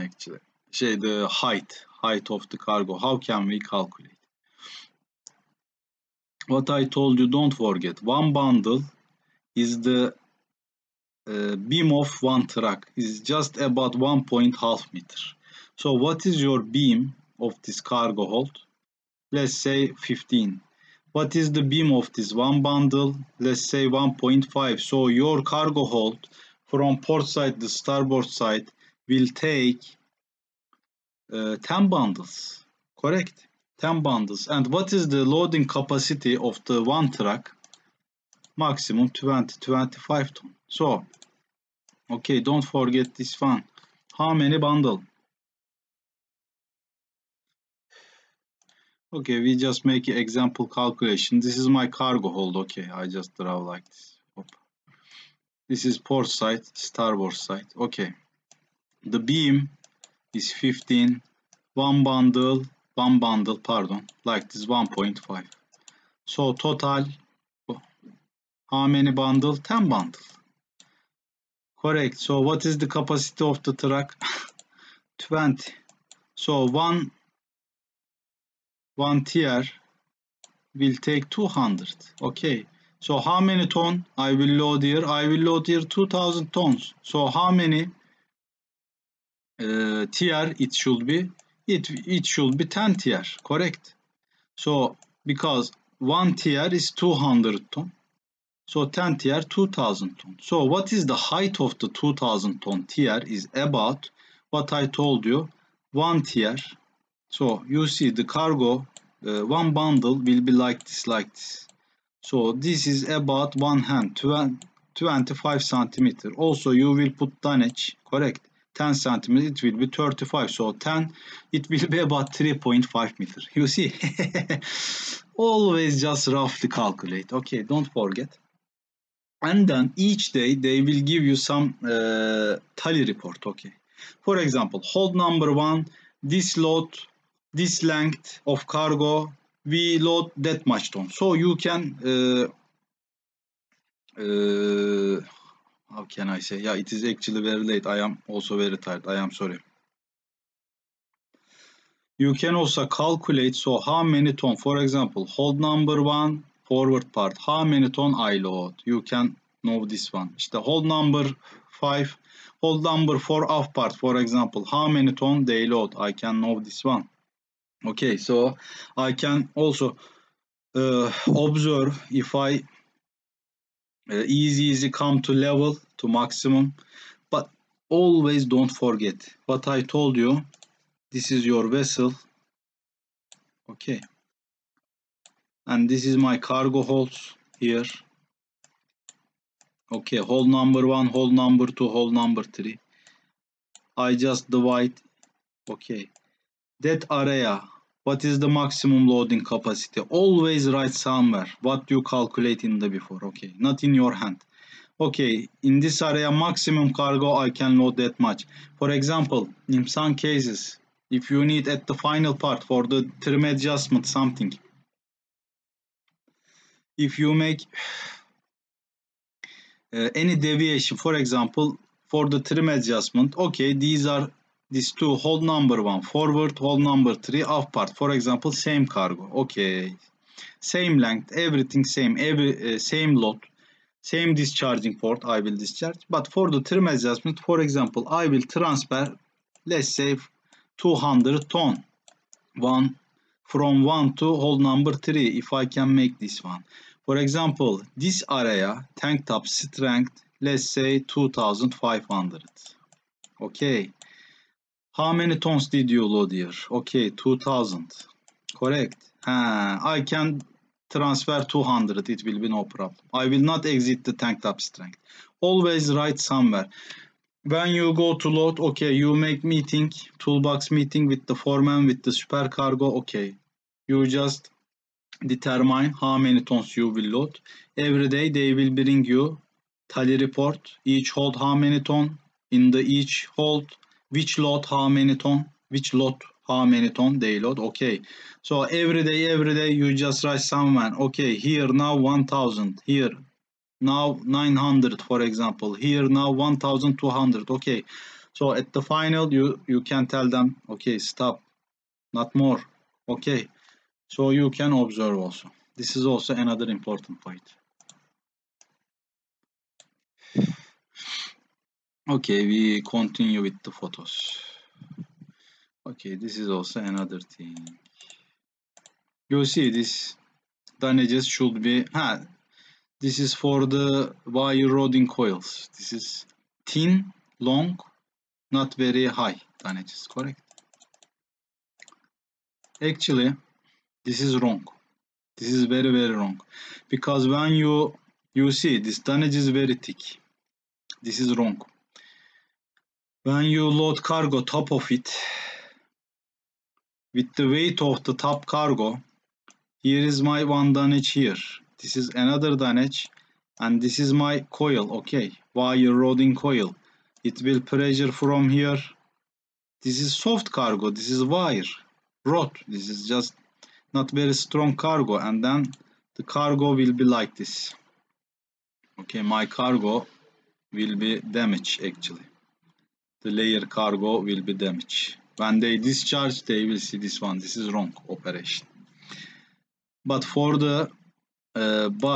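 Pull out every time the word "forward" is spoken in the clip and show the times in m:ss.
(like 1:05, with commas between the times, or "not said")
2:36, 3:46.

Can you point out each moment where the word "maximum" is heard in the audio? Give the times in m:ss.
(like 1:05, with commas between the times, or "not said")
0:38, 2:56, 3:18, 3:26.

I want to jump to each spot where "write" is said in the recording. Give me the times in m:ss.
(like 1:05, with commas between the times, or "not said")
3:20, 4:25, 4:50.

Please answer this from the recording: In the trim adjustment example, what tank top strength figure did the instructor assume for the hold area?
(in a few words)
2500.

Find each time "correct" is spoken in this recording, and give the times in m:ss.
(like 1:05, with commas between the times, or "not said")
0:33, 1:11, 1:33, 1:58, 4:18, 5:30.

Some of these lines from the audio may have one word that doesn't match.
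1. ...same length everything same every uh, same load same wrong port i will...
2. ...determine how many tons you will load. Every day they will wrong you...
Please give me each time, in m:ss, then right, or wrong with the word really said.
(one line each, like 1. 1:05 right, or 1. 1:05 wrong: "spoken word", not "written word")
1. 3:50 wrong: "discharging", not "wrong"
2. 4:35 wrong: "bring", not "wrong".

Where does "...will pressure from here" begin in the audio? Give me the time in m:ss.
5:57.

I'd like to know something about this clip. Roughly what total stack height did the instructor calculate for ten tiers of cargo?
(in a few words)
3.5 meters.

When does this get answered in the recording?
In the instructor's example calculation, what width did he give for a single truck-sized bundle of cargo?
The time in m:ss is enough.
0:13.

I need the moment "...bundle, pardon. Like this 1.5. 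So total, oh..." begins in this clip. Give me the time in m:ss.
1:03.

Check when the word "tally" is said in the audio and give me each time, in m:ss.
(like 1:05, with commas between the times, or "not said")
2:12, 4:39.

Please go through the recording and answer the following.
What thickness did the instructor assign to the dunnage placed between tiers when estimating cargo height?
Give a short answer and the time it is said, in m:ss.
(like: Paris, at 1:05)
10 centimeters, at 1:58.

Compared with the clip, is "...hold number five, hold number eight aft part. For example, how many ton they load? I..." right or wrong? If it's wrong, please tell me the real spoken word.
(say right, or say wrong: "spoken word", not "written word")
wrong: "four", not "eight".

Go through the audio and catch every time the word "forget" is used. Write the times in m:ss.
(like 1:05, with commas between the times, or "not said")
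0:07, 0:42, 2:07, 2:58.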